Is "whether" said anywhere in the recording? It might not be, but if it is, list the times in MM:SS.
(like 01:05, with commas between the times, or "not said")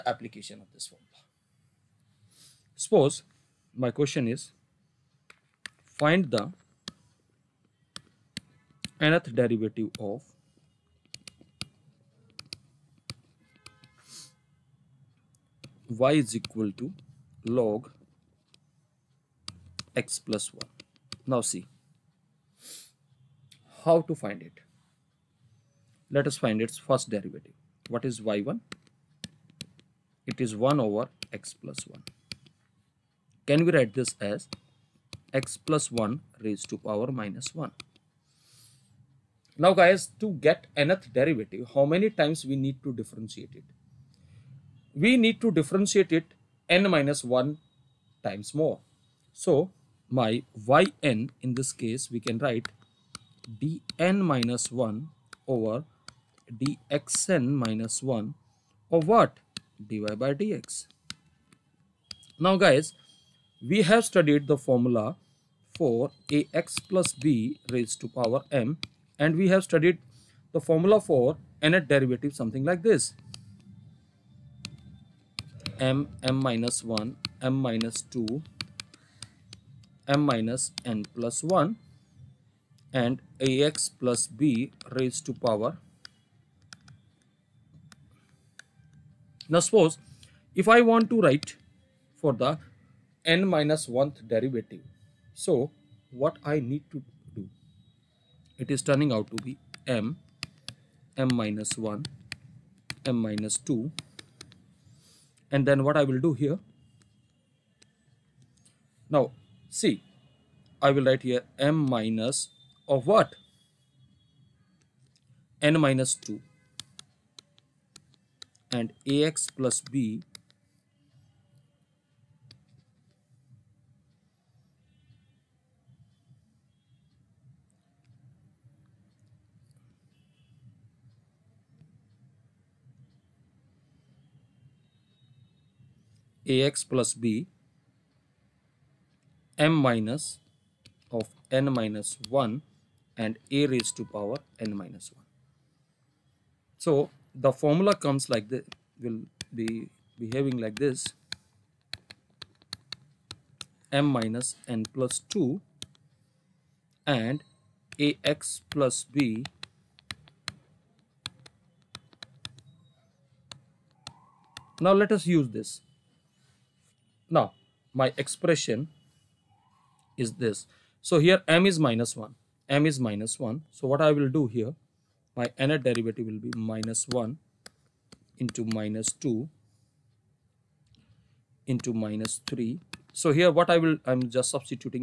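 not said.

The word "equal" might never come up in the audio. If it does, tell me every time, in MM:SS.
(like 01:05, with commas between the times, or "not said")
00:16.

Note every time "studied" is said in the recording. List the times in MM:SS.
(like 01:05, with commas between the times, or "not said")
01:04, 01:09.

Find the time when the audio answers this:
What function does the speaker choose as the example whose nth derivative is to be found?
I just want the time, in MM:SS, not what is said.
00:17.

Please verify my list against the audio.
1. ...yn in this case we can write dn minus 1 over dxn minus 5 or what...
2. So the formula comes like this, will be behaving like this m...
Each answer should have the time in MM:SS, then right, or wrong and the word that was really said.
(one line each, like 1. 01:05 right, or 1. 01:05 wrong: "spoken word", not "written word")
1. 00:51 wrong: "1", not "5"
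2. 02:26 right.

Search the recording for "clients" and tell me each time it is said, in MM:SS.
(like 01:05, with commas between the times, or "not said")
not said.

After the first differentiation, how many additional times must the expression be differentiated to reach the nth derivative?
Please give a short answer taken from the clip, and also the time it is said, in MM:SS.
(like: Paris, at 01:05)
n minus 1, at 00:46.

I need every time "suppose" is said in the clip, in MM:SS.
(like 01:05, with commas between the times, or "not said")
00:02, 01:29.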